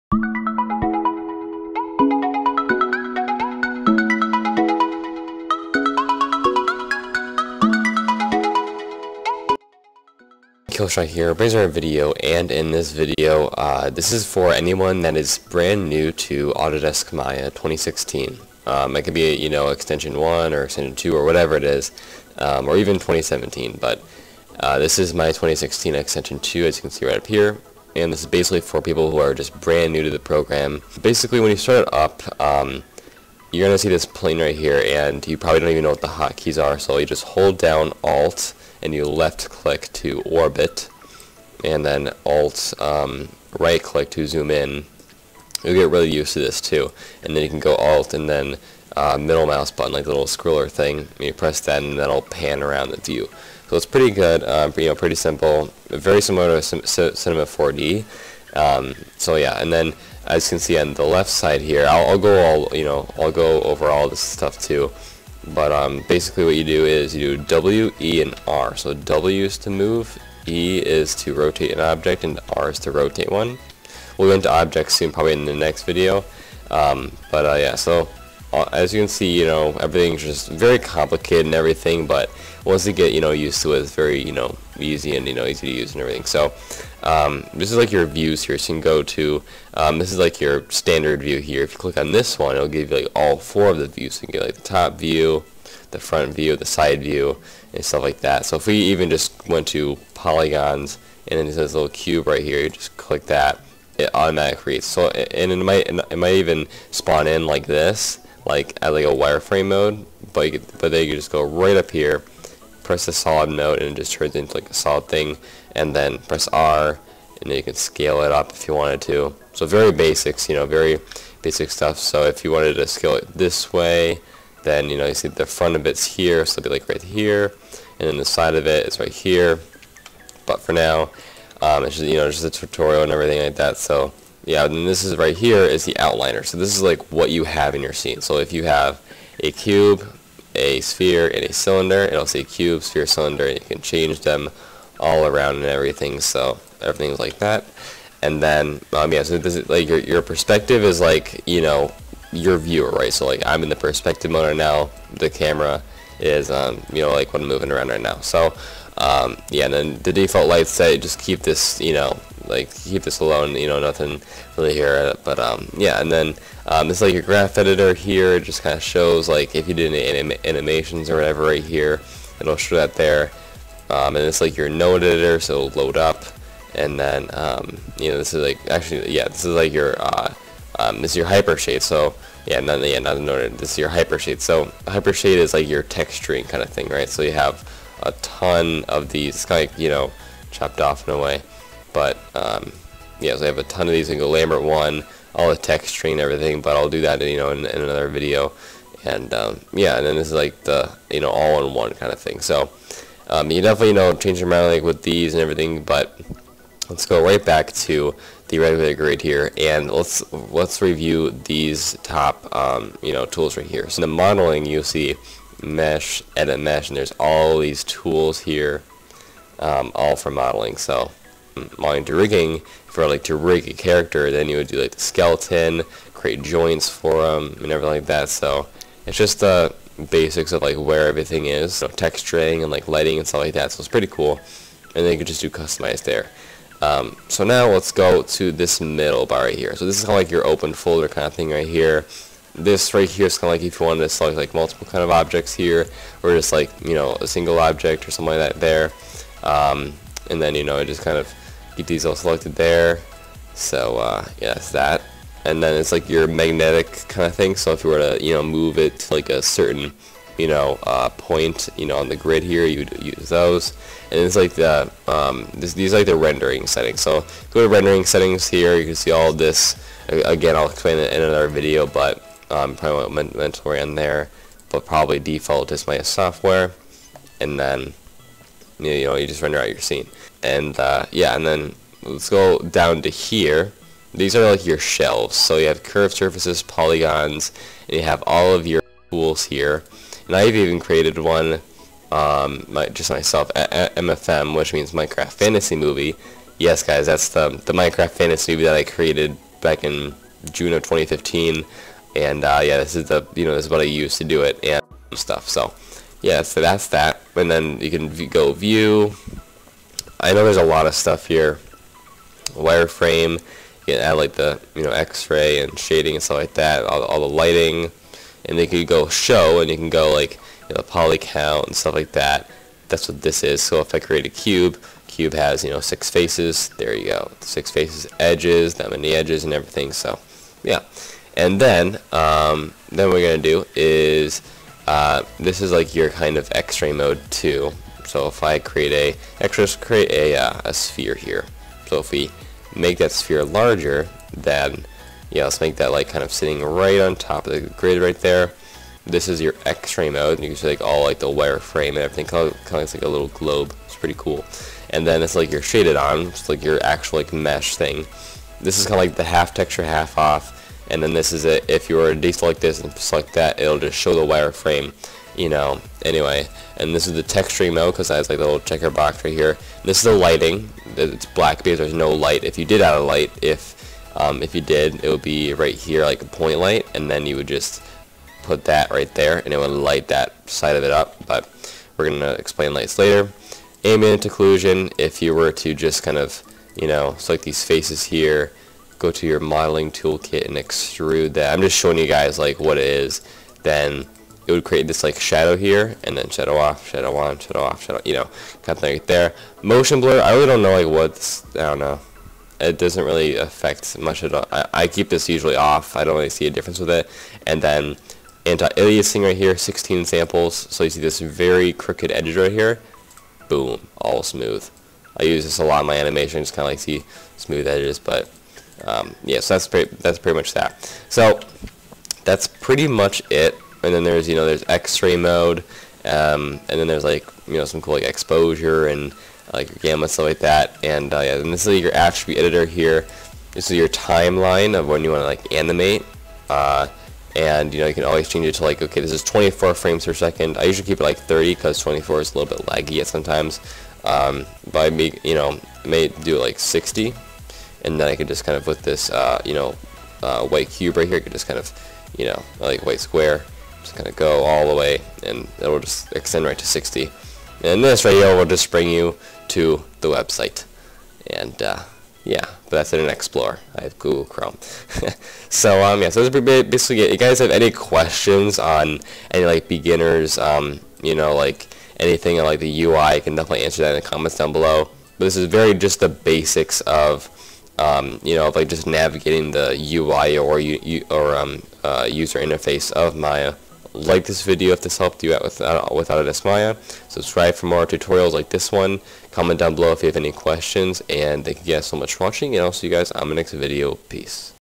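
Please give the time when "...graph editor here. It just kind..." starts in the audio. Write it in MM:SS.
02:47.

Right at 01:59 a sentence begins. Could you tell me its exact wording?
So very basics, you know, very basic stuff.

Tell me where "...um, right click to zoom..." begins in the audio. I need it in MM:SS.
00:42.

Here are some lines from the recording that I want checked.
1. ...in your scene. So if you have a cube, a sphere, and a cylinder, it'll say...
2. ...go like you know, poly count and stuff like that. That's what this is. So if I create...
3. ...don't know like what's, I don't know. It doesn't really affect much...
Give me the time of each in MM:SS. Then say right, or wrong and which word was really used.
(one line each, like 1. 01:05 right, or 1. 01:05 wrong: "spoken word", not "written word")
1. 02:17 right
2. 05:19 right
3. 06:40 right.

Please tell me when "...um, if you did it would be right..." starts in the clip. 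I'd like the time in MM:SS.
06:14.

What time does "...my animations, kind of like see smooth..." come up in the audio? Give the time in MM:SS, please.
06:55.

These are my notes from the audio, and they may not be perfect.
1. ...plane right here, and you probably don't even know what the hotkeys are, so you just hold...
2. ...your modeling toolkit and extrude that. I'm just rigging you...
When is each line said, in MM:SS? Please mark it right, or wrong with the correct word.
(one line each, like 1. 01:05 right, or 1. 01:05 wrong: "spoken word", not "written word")
1. 00:34 right
2. 06:29 wrong: "showing", not "rigging".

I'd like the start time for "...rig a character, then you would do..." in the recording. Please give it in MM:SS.
03:43.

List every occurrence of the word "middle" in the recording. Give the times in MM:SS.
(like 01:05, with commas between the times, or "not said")
00:49, 03:58.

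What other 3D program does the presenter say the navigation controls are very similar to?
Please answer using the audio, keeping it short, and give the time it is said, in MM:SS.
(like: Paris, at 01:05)
Cinema 4D, at 00:56.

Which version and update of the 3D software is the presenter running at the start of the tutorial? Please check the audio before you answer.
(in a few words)
2016 extension 2.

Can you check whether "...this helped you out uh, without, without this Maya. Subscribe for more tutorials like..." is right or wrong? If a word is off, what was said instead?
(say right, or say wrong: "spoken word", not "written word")
right.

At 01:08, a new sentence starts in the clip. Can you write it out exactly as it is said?
So W is to move, E is to rotate an object, and R is to rotate one.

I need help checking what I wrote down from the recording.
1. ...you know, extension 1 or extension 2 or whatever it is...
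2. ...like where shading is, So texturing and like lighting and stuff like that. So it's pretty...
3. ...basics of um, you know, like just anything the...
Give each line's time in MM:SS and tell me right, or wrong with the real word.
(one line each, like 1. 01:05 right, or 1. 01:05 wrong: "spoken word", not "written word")
1. 00:19 right
2. 03:50 wrong: "everything", not "shading"
3. 07:56 wrong: "navigating", not "anything".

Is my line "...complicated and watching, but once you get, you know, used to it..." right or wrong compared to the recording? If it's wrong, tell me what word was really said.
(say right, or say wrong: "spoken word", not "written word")
wrong: "everything", not "watching".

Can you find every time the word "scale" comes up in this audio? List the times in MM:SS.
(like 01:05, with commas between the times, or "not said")
01:57, 02:02.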